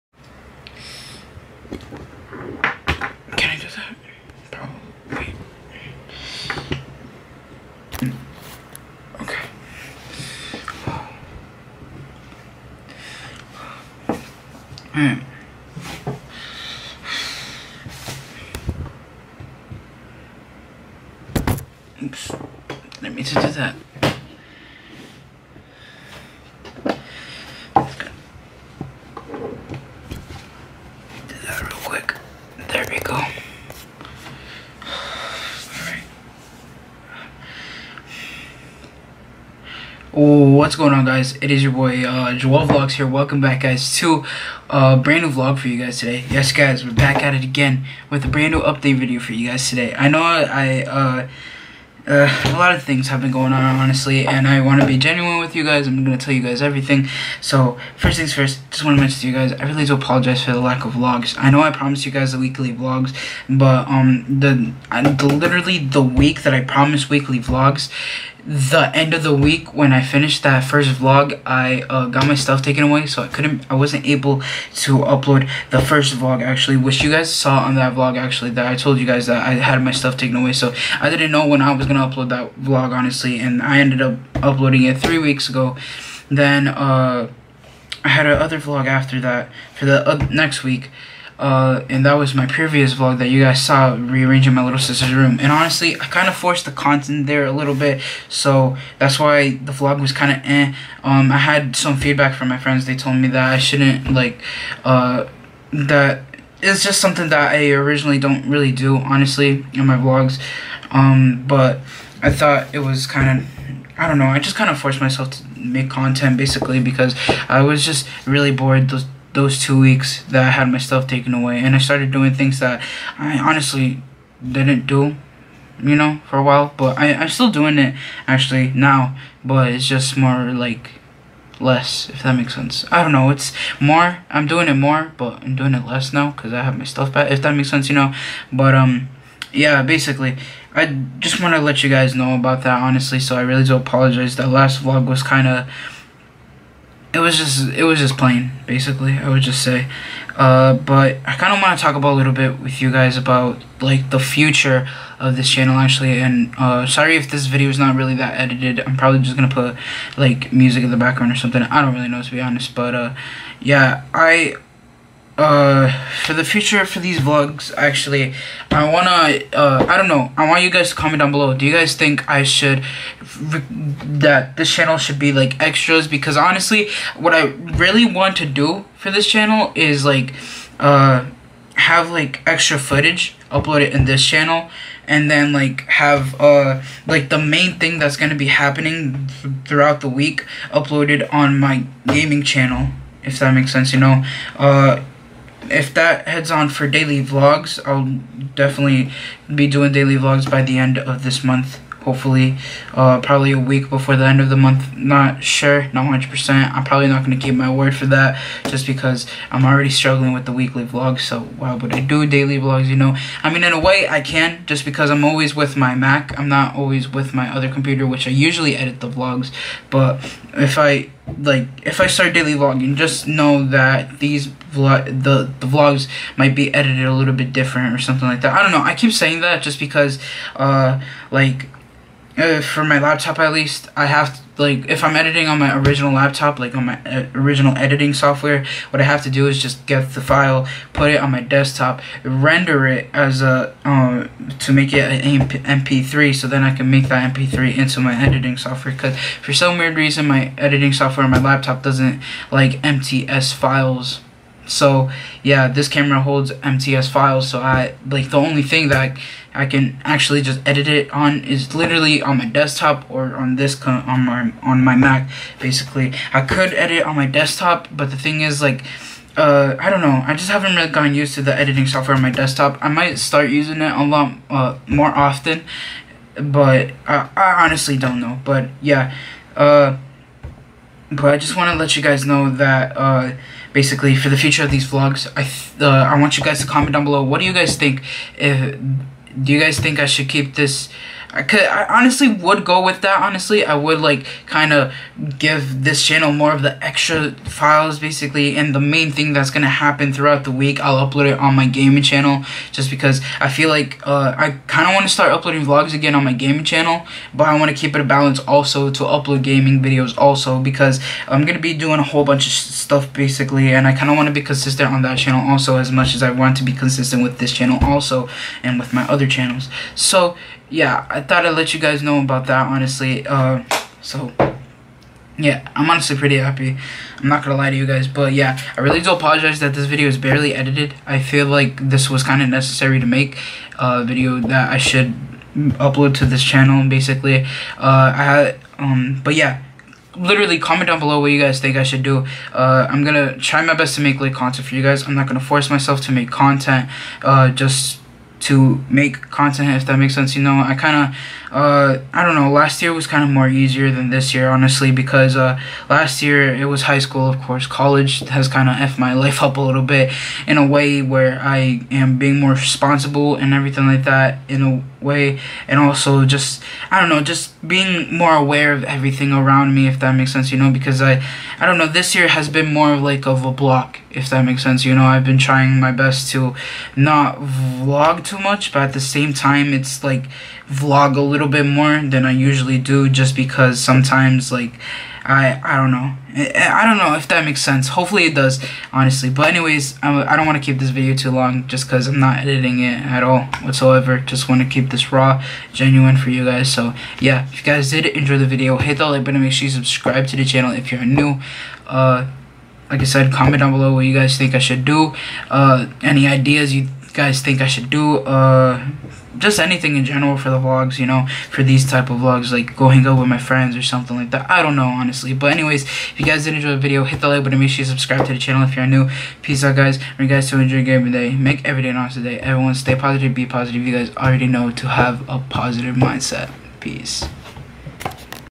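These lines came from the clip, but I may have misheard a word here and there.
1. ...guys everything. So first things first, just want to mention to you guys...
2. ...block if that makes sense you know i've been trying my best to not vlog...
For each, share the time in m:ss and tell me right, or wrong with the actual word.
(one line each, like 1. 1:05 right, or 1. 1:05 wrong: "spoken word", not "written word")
1. 0:56 right
2. 6:13 right.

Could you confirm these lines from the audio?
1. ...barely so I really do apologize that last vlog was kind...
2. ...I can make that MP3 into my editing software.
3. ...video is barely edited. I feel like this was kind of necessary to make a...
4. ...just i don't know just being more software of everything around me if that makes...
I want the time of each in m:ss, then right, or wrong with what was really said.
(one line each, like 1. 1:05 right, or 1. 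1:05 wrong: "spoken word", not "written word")
1. 2:22 wrong: "honestly", not "barely"
2. 4:06 right
3. 5:29 right
4. 6:06 wrong: "aware", not "software".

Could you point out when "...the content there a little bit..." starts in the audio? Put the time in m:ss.
1:36.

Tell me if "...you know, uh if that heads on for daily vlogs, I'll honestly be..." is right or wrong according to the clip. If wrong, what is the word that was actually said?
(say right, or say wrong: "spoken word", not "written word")
wrong: "definitely", not "honestly".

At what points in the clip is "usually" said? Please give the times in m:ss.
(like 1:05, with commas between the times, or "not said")
3:38, 6:22.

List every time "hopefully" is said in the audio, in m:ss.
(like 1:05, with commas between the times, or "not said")
3:22, 6:27.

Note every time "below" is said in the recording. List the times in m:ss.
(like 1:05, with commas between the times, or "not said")
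2:51, 4:47, 5:40, 6:43.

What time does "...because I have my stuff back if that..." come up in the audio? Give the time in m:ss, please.
2:16.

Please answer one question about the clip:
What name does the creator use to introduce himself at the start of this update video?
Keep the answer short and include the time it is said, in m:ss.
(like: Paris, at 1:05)
Joel Vlogs, at 0:42.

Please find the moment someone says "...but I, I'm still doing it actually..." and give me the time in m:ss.
2:06.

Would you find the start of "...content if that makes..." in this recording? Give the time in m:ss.
5:49.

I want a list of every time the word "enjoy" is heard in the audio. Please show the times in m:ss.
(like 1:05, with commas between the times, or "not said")
6:38, 6:56, 7:00.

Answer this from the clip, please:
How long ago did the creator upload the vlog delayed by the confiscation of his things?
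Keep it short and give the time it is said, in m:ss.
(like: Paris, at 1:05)
3 weeks ago, at 1:24.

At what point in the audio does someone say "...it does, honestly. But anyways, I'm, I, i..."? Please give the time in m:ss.
6:28.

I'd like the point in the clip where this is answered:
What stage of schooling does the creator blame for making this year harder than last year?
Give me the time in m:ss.
5:57.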